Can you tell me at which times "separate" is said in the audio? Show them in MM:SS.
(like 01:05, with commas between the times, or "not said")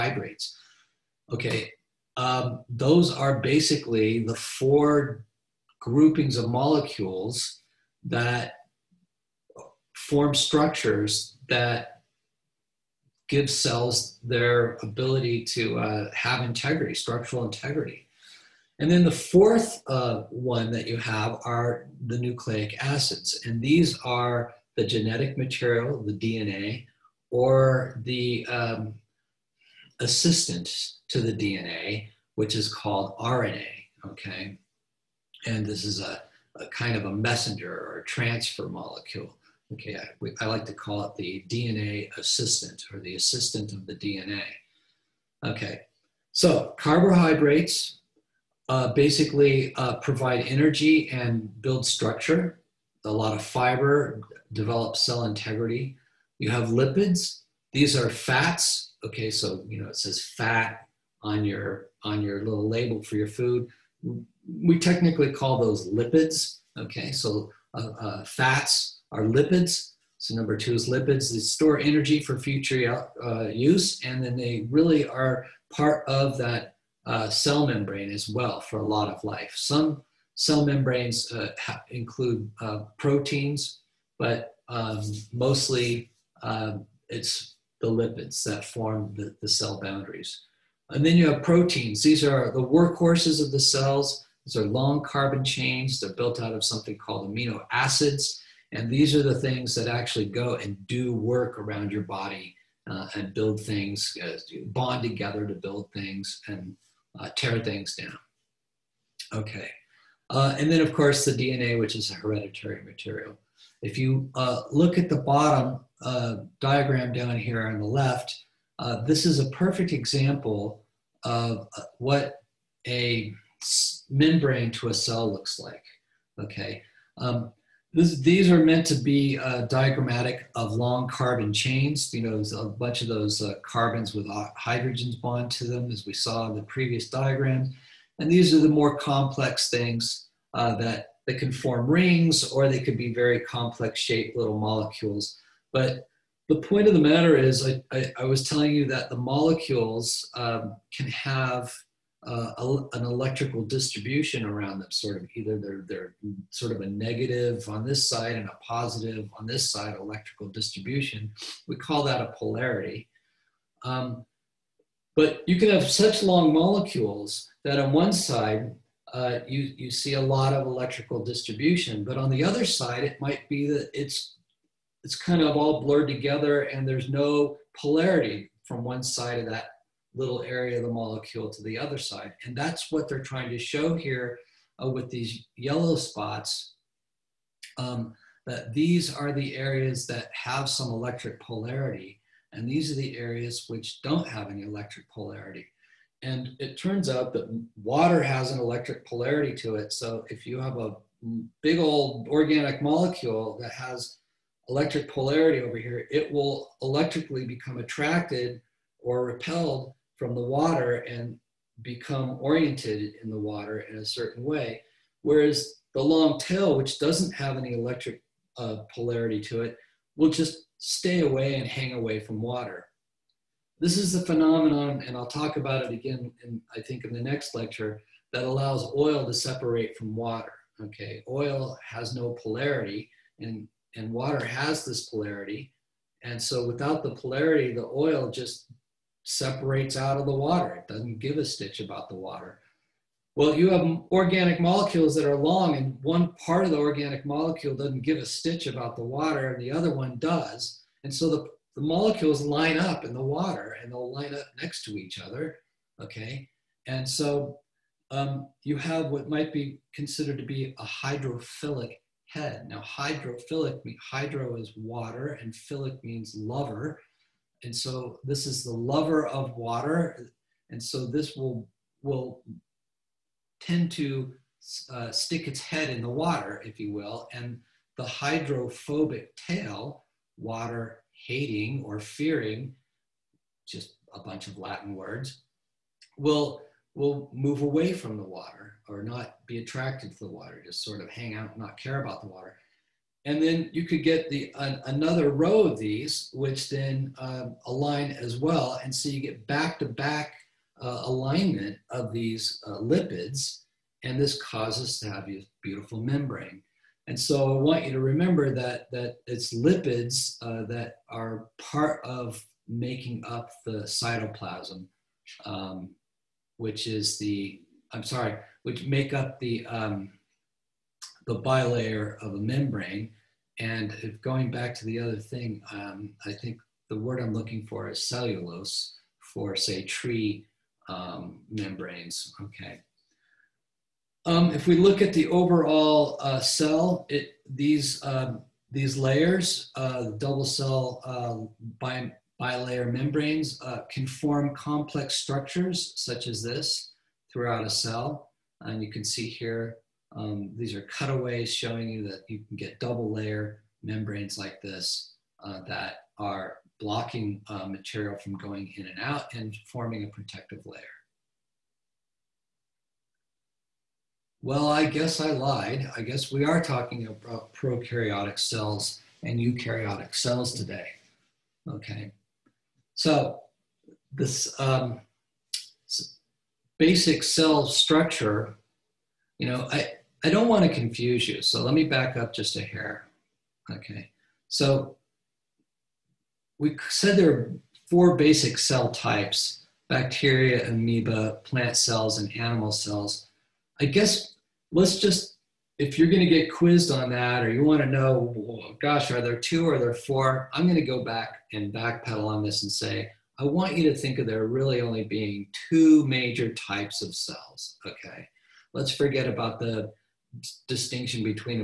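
03:49, 03:59.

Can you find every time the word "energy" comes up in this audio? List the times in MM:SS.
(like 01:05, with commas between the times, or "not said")
00:50, 01:11.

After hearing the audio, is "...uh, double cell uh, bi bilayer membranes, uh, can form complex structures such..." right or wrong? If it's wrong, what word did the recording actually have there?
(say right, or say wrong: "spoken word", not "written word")
right.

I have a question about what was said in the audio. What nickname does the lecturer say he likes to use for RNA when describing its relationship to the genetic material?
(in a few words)
the DNA assistant.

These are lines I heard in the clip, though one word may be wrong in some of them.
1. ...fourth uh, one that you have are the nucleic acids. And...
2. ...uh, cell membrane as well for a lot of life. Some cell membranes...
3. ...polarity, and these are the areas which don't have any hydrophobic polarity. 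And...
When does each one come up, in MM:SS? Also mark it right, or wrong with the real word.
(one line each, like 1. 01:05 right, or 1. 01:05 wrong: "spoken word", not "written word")
1. 00:19 right
2. 01:17 right
3. 03:11 wrong: "electric", not "hydrophobic".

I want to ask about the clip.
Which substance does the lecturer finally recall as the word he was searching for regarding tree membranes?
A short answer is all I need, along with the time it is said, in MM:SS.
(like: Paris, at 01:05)
cellulose, at 05:28.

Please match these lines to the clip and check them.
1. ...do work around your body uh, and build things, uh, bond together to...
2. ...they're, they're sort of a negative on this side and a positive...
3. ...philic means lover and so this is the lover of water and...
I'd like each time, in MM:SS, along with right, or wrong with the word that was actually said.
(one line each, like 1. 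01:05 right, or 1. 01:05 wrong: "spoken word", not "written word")
1. 01:40 right
2. 02:35 right
3. 04:25 right.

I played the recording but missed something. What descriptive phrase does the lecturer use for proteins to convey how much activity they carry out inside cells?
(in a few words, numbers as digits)
workhorses of the cells.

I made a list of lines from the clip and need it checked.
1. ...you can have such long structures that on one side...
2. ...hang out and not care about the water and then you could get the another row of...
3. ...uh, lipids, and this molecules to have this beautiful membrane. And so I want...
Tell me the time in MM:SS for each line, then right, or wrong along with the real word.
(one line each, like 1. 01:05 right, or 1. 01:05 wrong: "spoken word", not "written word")
1. 02:45 wrong: "molecules", not "structures"
2. 04:51 right
3. 05:02 wrong: "causes", not "molecules".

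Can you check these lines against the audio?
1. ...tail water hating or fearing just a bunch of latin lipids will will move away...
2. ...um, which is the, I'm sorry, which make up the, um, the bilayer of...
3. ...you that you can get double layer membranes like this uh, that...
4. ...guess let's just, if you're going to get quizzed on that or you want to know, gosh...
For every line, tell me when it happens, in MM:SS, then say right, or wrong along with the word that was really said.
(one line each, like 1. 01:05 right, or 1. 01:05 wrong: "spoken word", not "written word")
1. 04:39 wrong: "words", not "lipids"
2. 05:15 right
3. 05:51 right
4. 06:33 right.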